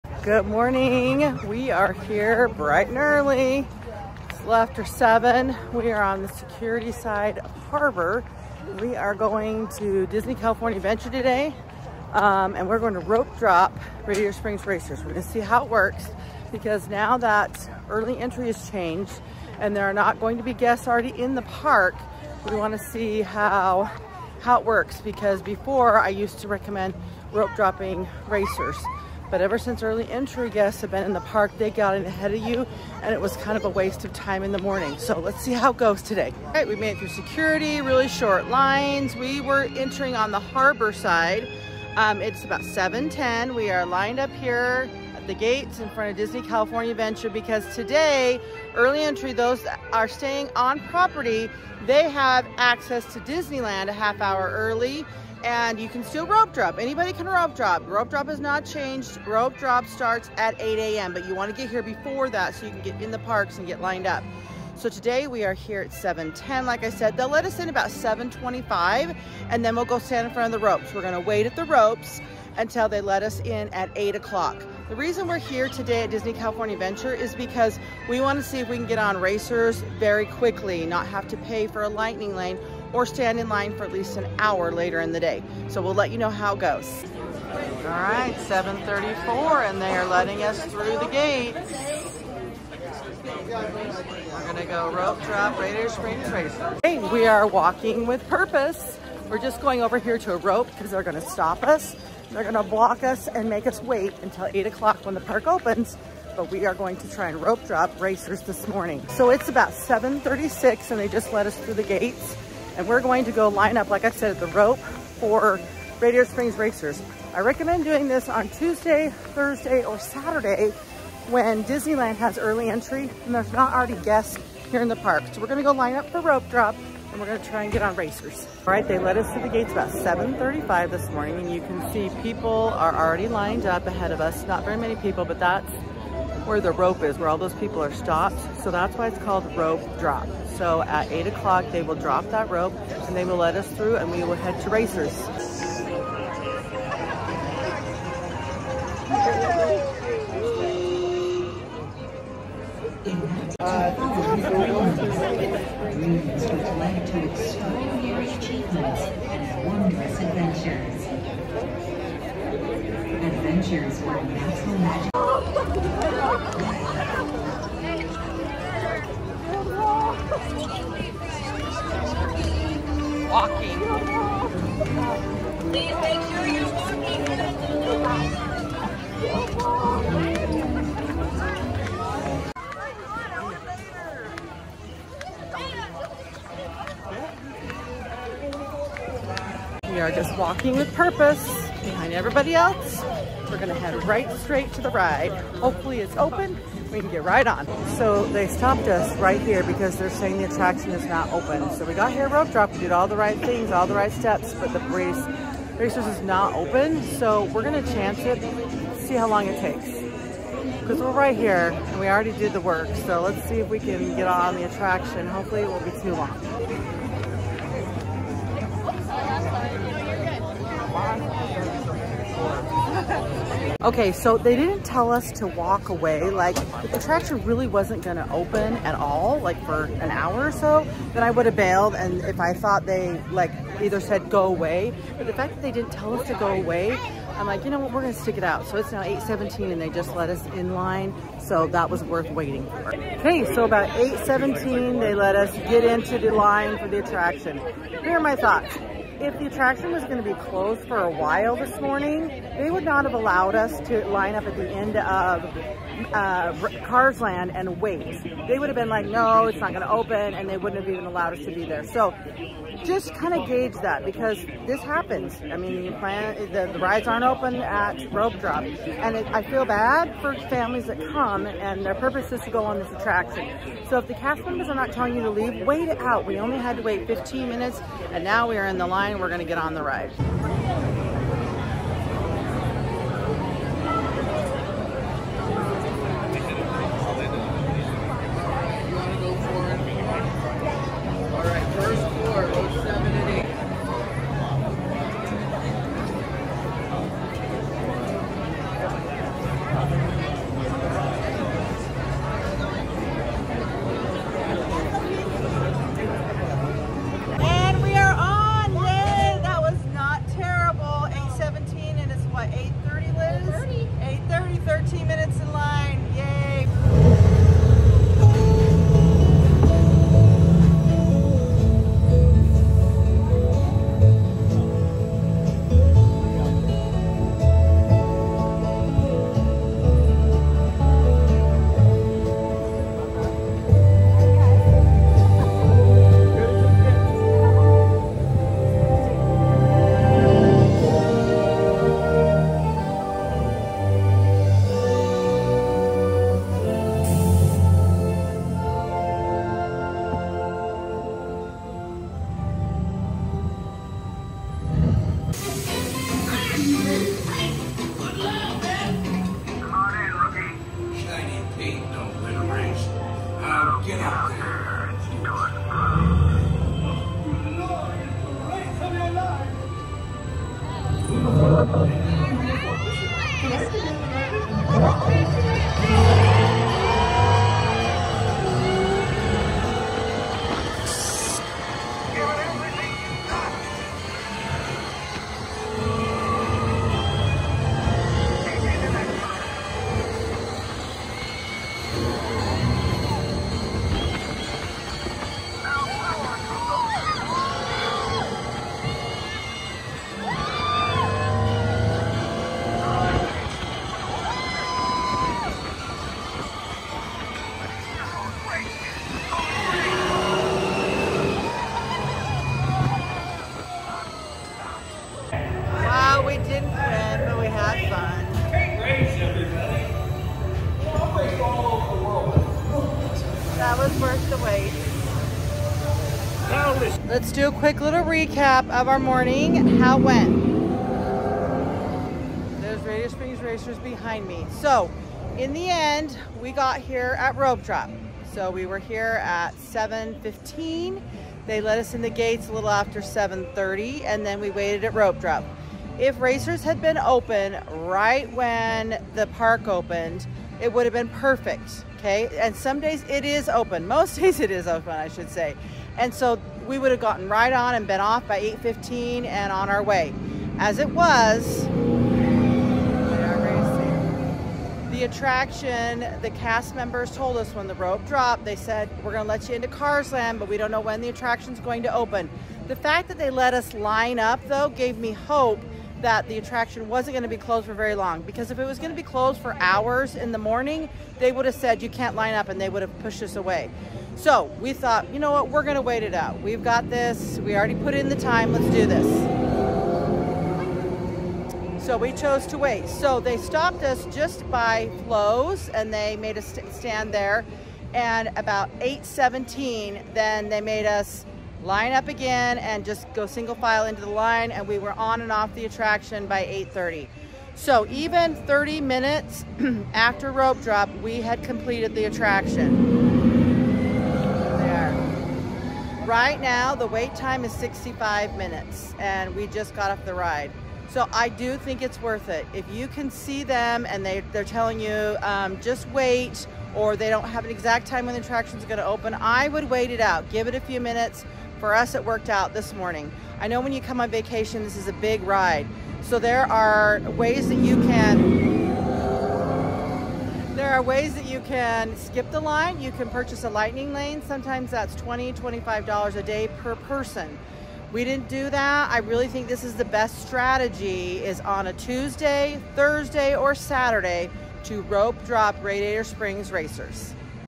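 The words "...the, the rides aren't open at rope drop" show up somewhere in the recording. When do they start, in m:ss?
4:26.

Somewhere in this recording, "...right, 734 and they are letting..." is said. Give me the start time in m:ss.
1:27.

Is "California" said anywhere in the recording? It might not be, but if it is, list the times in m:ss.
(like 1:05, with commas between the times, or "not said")
0:10, 0:46, 1:16.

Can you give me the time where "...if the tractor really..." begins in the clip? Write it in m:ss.
3:46.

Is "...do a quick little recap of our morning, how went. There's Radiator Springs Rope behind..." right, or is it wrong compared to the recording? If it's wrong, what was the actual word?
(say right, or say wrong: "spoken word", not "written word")
wrong: "Racers", not "Rope".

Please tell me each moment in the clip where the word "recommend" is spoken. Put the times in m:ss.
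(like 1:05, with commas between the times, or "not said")
0:26, 1:57.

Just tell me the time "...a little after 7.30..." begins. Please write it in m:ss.
7:22.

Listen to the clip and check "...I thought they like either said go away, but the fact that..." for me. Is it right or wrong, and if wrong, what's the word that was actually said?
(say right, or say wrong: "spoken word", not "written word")
right.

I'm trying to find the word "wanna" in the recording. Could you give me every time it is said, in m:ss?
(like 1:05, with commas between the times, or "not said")
0:22, 1:18.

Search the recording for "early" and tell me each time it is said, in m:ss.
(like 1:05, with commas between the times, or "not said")
0:02, 0:17, 0:29, 0:48, 0:54, 2:02.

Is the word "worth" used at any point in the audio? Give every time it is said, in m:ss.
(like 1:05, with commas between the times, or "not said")
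4:02, 8:42.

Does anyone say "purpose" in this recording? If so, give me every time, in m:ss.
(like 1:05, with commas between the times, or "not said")
1:38, 3:10, 4:31.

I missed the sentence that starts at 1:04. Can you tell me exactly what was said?
So today we are here at 7.10.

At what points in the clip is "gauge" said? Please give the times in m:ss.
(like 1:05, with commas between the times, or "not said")
4:23.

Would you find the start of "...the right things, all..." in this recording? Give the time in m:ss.
3:23.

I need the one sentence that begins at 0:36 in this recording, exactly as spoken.
All right, we made it through security, really short lines.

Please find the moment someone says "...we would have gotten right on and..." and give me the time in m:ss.
7:36.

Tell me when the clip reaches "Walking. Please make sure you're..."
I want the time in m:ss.
2:53.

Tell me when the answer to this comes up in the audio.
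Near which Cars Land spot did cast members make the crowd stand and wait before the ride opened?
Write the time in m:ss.
8:15.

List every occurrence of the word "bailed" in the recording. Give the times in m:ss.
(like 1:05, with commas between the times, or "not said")
3:51.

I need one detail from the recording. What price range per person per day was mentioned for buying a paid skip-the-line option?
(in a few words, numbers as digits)
$20-25.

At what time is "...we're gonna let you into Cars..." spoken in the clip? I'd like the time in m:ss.
7:49.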